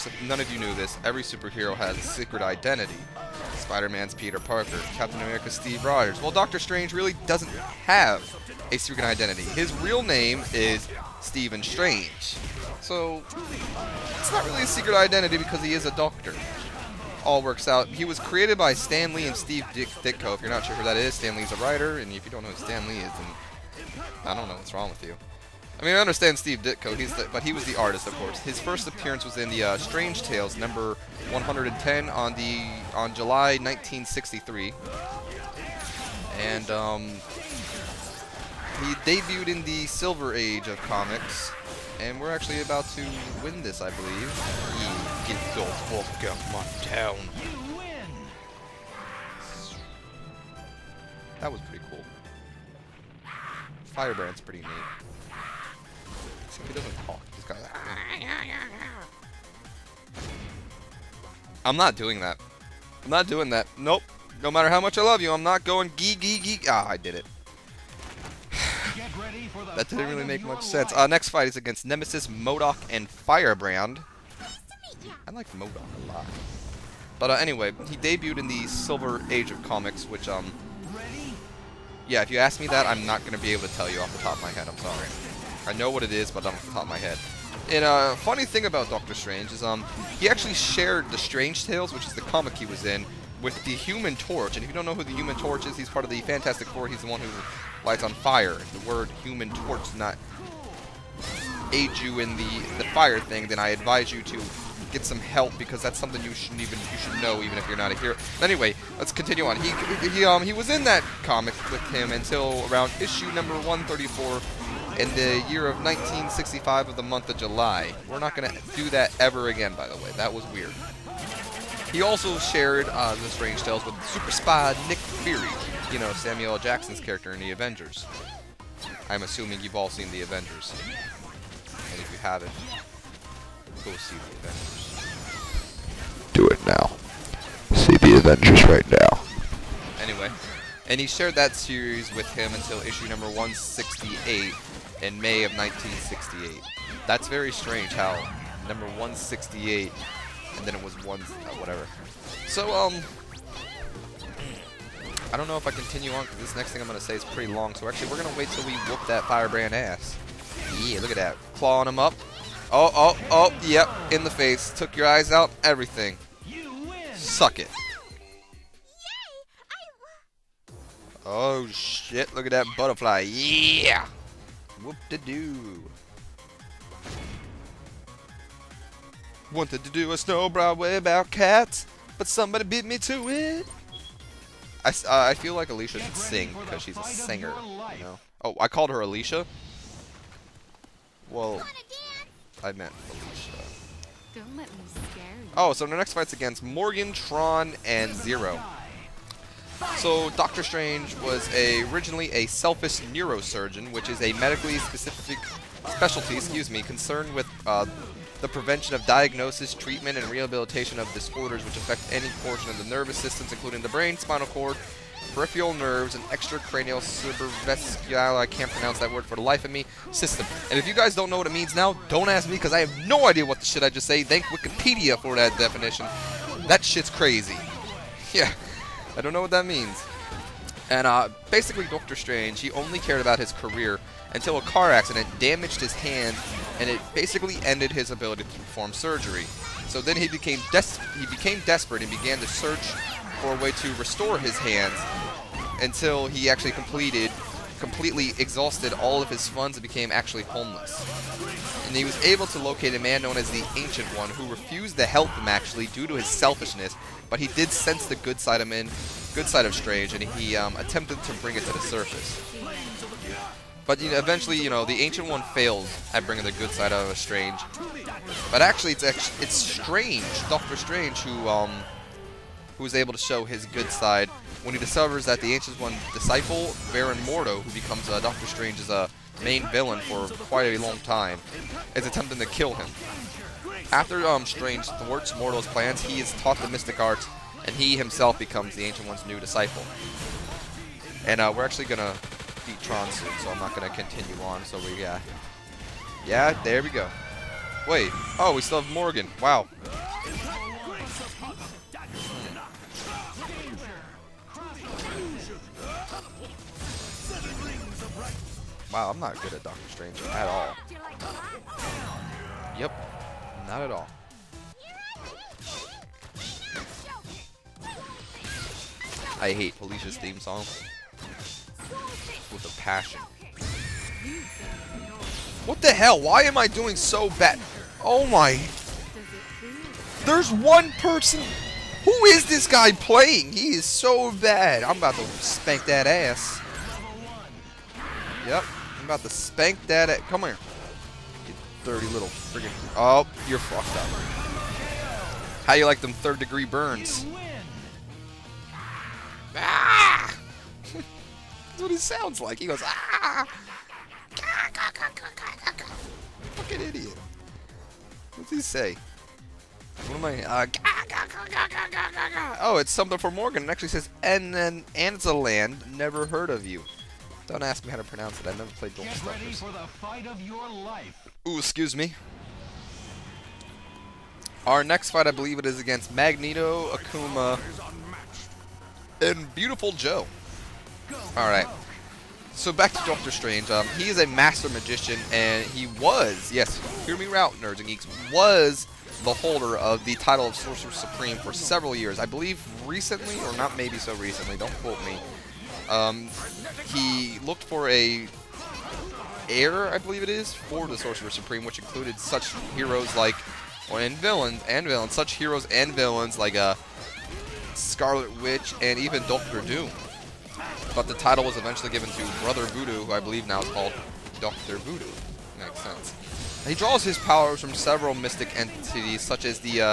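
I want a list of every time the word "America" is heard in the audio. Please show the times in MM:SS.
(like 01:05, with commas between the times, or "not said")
00:05.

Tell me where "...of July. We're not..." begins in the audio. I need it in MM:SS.
01:57.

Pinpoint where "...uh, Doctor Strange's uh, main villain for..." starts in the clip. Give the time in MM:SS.
04:38.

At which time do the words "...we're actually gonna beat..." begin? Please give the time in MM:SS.
04:51.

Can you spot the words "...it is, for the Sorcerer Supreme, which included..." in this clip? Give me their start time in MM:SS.
06:40.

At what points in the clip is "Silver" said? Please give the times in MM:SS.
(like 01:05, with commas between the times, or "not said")
00:39, 01:18.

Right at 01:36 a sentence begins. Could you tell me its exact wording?
He's the one who lights on fire.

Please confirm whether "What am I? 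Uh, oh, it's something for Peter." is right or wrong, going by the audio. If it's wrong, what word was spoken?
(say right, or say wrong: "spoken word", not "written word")
wrong: "Morgan", not "Peter".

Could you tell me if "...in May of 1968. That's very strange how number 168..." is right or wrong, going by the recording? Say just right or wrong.
right.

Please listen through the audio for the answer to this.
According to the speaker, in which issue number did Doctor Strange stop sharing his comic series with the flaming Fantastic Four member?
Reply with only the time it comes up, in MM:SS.
01:53.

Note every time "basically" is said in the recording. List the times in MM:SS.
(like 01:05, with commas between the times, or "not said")
03:51, 03:57.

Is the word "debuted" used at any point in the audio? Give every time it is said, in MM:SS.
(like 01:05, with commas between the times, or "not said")
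00:39, 01:17.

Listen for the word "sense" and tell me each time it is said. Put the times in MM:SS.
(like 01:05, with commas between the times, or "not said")
01:10, 04:17, 06:55.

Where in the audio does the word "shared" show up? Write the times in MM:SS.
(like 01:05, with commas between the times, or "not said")
01:30, 02:02, 02:21.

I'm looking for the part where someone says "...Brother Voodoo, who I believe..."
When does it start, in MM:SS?
06:52.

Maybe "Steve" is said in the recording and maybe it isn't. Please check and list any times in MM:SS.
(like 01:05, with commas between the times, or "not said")
00:05, 00:19, 00:26.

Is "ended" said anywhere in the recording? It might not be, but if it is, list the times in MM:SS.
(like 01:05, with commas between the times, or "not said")
03:57.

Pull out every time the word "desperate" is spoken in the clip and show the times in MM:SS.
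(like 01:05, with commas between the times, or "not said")
04:01.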